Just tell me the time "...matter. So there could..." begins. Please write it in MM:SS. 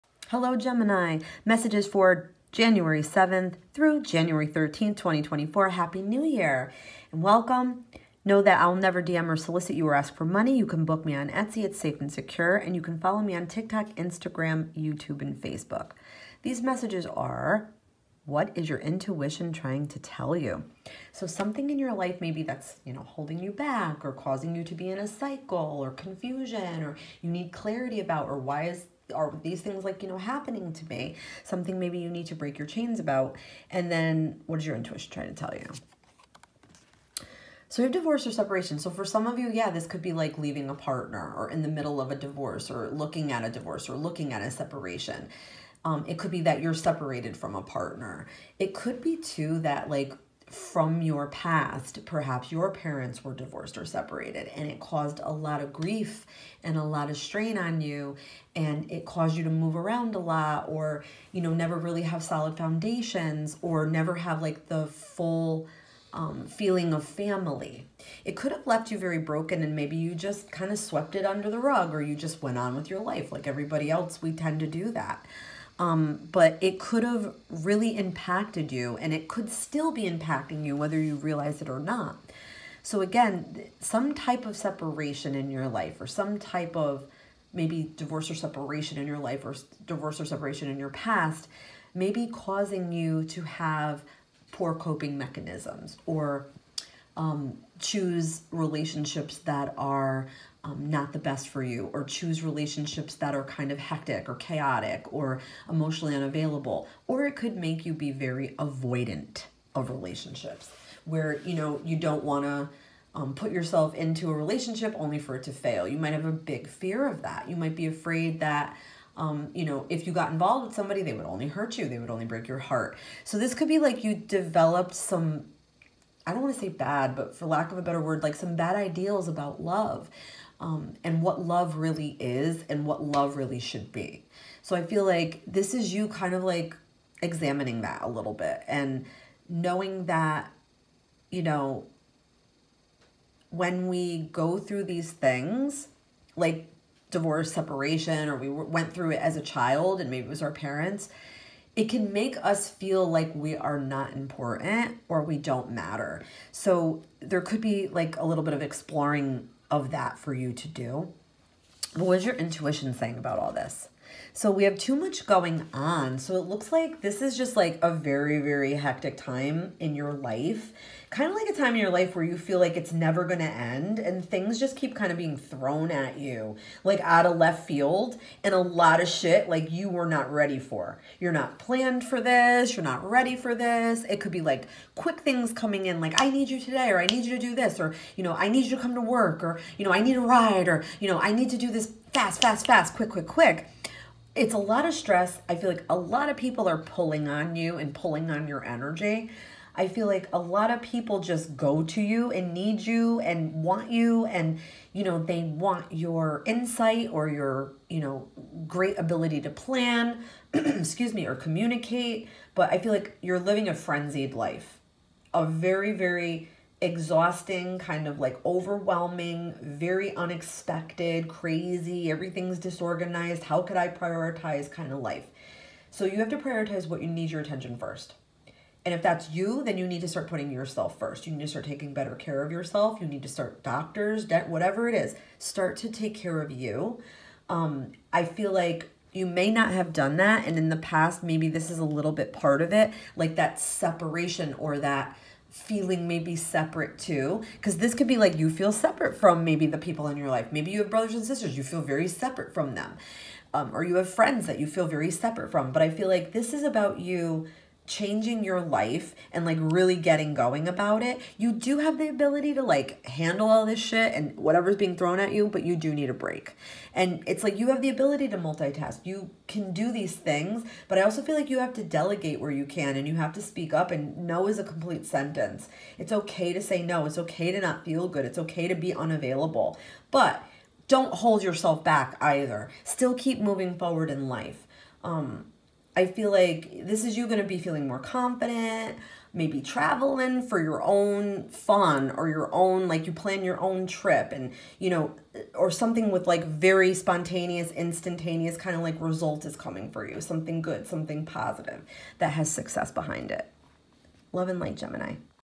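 02:35.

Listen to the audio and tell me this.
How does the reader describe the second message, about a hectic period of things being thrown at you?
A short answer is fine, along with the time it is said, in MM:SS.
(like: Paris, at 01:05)
Too much going on, at 02:44.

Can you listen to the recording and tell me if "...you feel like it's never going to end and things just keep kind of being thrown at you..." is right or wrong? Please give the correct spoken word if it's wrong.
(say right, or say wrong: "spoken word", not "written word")
right.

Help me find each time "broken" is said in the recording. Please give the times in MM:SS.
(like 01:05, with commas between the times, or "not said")
01:09.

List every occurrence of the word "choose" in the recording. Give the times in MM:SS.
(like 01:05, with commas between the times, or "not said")
01:37, 01:42.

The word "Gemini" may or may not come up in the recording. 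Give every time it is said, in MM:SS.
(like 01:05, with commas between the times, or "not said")
00:00, 05:04.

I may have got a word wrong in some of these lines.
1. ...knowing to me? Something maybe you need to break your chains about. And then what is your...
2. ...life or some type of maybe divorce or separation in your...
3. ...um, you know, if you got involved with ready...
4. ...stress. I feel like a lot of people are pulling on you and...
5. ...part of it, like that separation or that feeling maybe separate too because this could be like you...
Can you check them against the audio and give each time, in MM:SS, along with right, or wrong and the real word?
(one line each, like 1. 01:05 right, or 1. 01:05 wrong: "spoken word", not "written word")
1. 00:30 wrong: "happening", not "knowing"
2. 01:25 right
3. 01:59 wrong: "somebody", not "ready"
4. 03:14 right
5. 04:02 right.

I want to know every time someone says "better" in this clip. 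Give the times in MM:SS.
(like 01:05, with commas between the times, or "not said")
02:07, 03:51.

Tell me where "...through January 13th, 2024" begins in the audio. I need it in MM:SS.
00:03.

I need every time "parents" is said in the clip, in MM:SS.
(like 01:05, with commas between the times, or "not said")
00:52, 02:30.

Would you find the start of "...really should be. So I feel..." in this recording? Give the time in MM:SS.
02:13.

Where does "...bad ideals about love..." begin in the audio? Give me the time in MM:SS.
02:08.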